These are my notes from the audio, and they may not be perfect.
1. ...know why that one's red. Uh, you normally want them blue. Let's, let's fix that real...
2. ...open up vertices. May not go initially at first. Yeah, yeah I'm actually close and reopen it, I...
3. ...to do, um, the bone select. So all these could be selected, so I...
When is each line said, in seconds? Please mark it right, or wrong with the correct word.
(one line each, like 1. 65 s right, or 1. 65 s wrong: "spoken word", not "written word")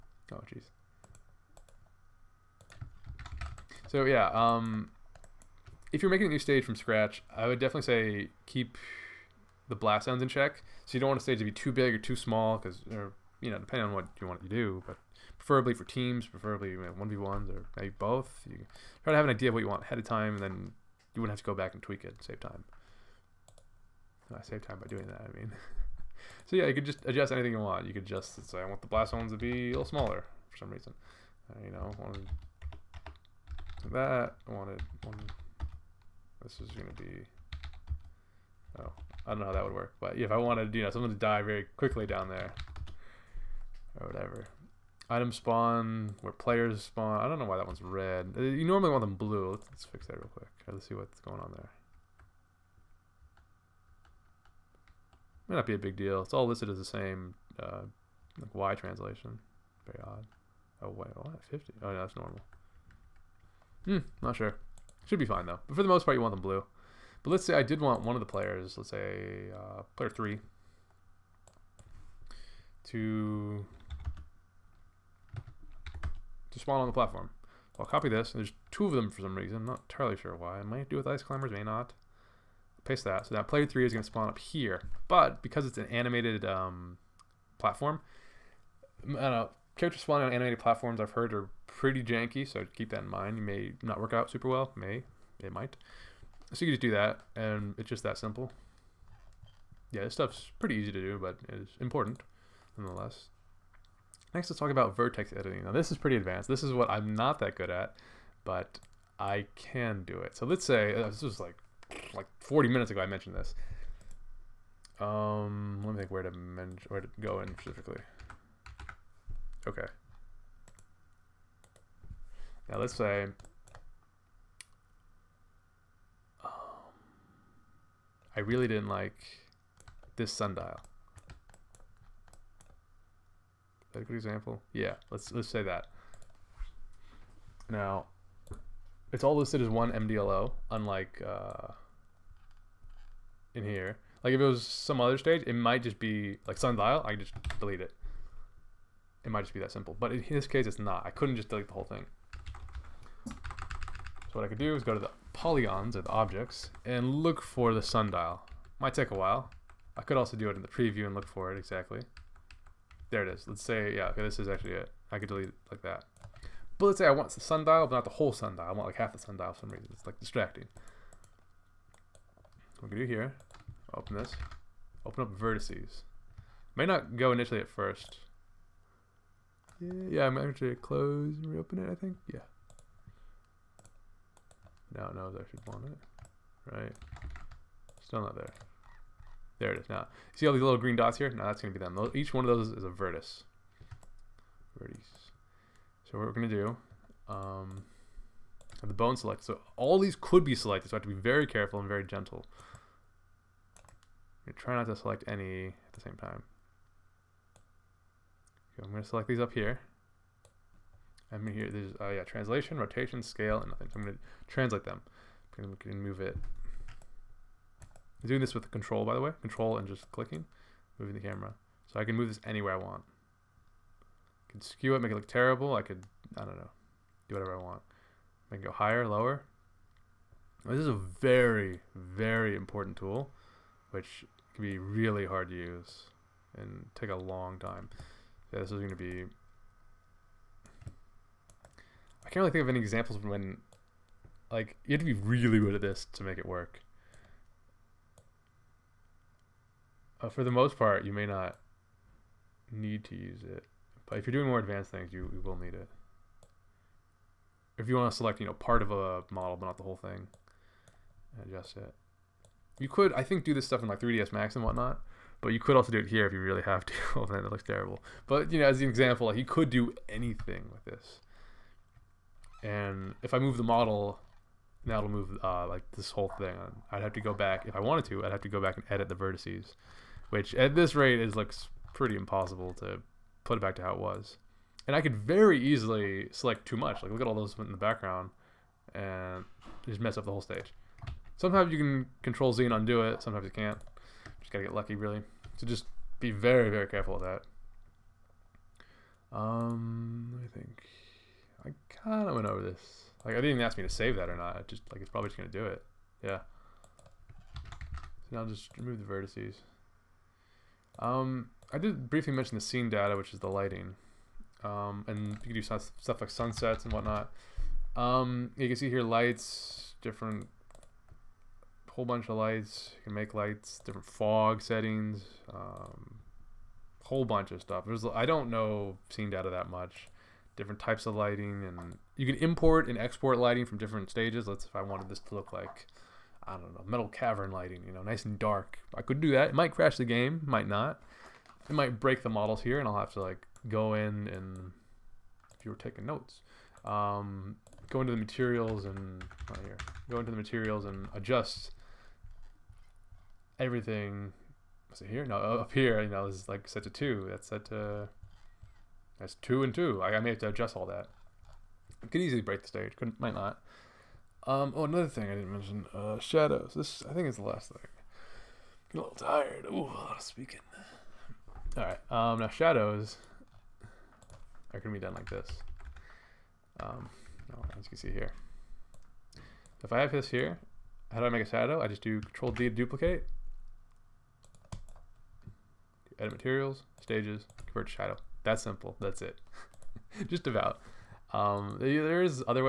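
1. 47 s right
2. 175 s right
3. 196 s right.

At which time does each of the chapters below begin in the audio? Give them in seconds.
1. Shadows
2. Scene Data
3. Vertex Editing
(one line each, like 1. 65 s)
1. 372 s
2. 314 s
3. 104 s.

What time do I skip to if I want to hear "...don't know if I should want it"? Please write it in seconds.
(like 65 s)
185 s.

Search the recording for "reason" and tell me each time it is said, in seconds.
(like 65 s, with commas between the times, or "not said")
30 s, 79 s, 169 s.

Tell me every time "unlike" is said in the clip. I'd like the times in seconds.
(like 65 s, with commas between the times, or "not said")
140 s.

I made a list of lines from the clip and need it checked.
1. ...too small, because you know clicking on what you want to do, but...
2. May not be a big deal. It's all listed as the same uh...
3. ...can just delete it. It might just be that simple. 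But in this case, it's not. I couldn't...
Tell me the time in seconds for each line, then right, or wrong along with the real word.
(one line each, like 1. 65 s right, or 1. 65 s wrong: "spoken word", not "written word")
1. 11 s wrong: "depending", not "clicking"
2. 55 s right
3. 147 s right.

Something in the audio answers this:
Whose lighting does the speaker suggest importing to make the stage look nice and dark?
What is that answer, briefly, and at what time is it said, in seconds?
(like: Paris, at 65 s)
Metal Cavern, at 336 s.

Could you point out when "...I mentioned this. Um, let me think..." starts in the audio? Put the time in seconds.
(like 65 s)
112 s.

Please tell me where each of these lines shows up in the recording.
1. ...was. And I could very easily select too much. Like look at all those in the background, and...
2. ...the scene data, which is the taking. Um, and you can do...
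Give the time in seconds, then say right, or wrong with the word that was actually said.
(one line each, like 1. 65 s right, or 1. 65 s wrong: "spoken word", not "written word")
1. 283 s right
2. 312 s wrong: "lighting", not "taking".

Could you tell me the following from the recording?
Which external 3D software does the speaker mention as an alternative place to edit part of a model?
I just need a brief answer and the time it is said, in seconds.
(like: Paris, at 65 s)
3ds Max, at 263 s.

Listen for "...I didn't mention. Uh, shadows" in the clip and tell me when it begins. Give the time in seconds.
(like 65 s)
365 s.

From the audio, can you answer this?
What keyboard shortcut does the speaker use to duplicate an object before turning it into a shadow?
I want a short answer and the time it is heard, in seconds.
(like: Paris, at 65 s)
Control D, at 382 s.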